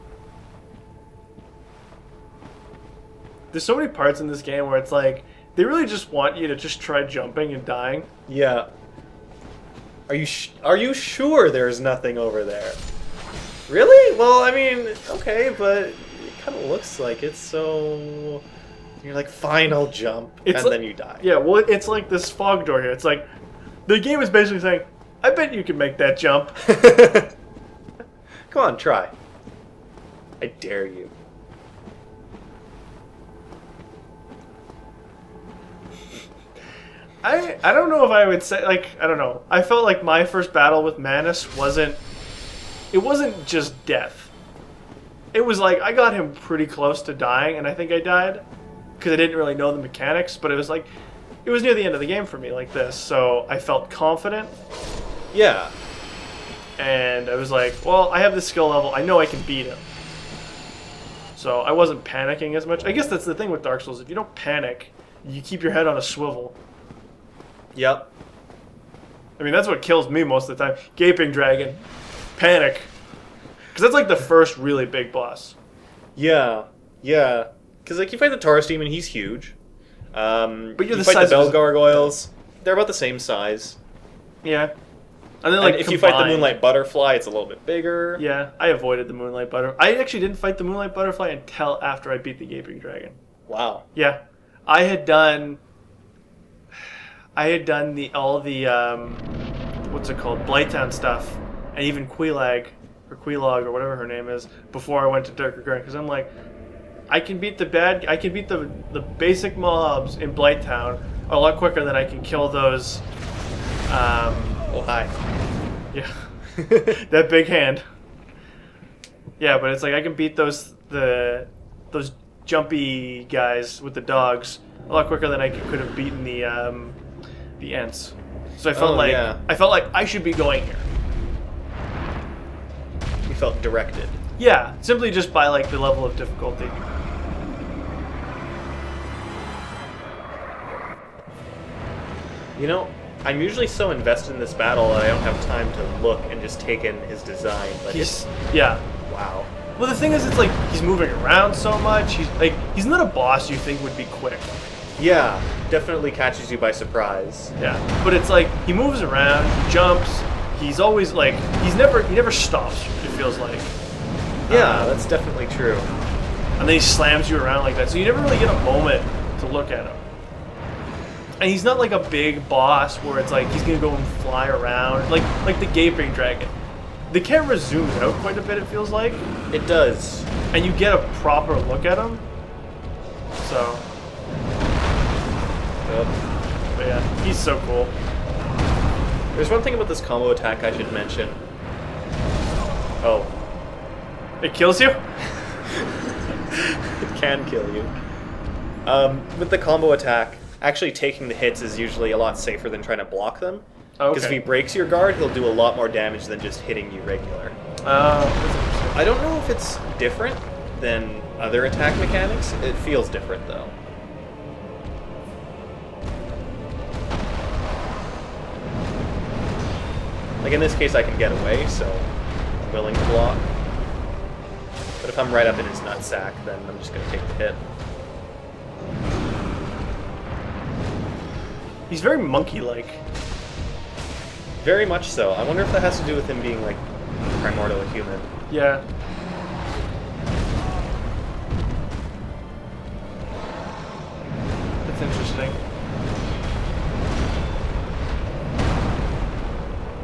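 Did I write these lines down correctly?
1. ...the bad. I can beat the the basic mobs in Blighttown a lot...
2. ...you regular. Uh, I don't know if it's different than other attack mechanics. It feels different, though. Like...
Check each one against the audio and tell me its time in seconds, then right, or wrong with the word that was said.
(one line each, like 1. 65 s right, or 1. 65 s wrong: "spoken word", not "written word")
1. 107 s right
2. 206 s right.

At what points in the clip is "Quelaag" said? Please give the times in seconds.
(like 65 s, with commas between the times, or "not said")
102 s.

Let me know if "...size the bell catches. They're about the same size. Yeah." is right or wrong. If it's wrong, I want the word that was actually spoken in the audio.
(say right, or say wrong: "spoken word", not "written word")
wrong: "gargoyles", not "catches".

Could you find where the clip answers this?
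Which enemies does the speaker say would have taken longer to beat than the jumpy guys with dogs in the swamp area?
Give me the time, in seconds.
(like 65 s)
127 s.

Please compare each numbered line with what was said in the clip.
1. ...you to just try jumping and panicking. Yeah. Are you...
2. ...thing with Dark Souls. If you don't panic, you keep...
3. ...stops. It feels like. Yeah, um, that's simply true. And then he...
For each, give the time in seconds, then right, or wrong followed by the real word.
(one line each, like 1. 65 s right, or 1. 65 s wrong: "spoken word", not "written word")
1. 6 s wrong: "dying", not "panicking"
2. 63 s right
3. 162 s wrong: "definitely", not "simply".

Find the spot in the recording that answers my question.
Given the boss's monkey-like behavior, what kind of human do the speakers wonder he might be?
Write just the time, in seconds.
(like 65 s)
237 s.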